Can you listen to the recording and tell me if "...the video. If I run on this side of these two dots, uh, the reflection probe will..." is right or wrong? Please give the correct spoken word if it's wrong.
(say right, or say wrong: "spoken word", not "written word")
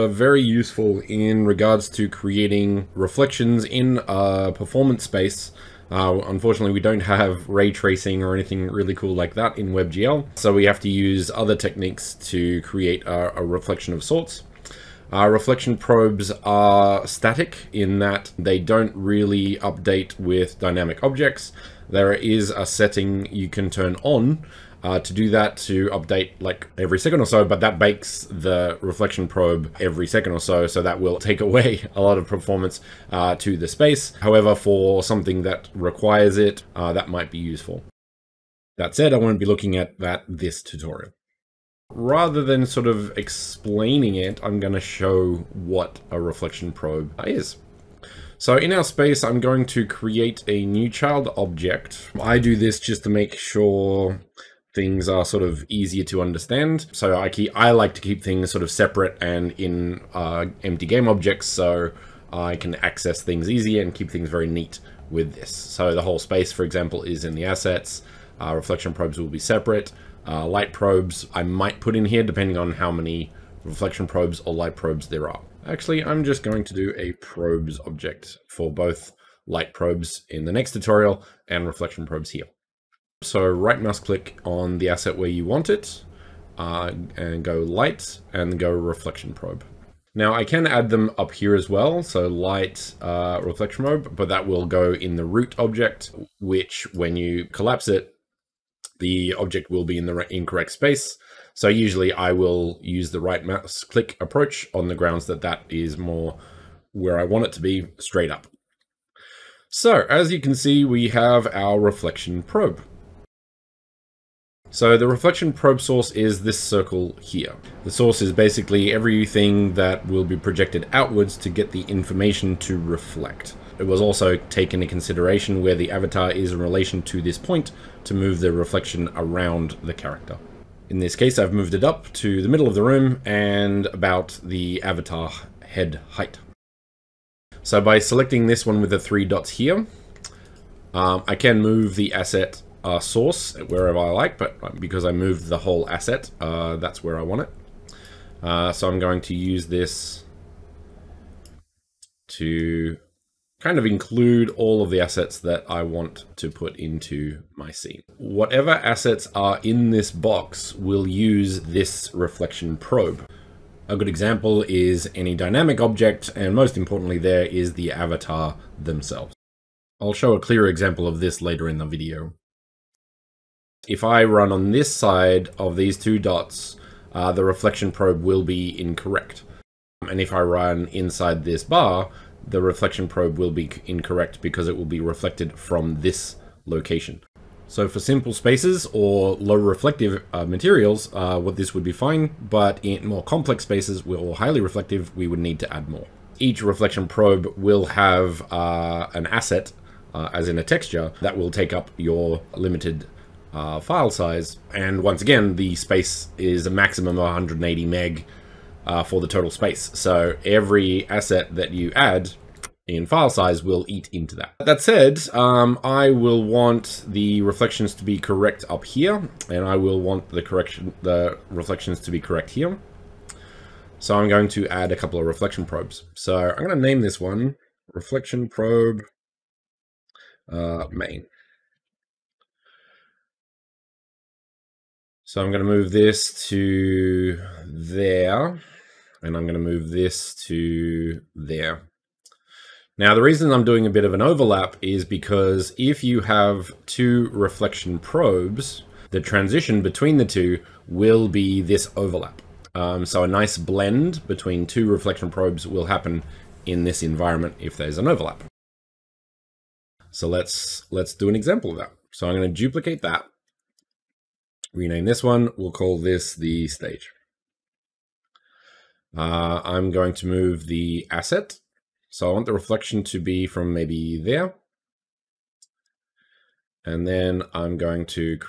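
right.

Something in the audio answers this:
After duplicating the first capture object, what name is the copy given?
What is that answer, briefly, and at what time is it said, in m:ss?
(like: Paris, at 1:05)
stage, at 4:26.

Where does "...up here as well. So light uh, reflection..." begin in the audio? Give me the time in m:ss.
1:31.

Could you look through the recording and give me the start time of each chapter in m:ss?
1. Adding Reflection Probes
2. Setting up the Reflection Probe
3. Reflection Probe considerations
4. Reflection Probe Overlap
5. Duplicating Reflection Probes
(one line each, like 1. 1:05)
1. 0:47
2. 1:52
3. 2:52
4. 4:02
5. 4:18.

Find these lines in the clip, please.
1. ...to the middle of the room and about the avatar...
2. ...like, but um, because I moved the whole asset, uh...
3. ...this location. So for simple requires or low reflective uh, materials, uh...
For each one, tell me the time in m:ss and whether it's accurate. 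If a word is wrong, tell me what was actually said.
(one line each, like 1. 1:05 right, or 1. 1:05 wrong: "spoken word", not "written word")
1. 2:12 right
2. 2:24 right
3. 3:06 wrong: "spaces", not "requires".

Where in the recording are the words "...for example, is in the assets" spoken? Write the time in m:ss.
1:06.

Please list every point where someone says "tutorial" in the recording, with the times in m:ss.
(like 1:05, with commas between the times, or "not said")
0:40, 1:20.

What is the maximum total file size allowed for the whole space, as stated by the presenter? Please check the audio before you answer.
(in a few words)
180 MB.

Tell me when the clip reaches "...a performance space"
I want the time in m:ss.
0:04.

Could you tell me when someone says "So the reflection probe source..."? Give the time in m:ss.
1:54.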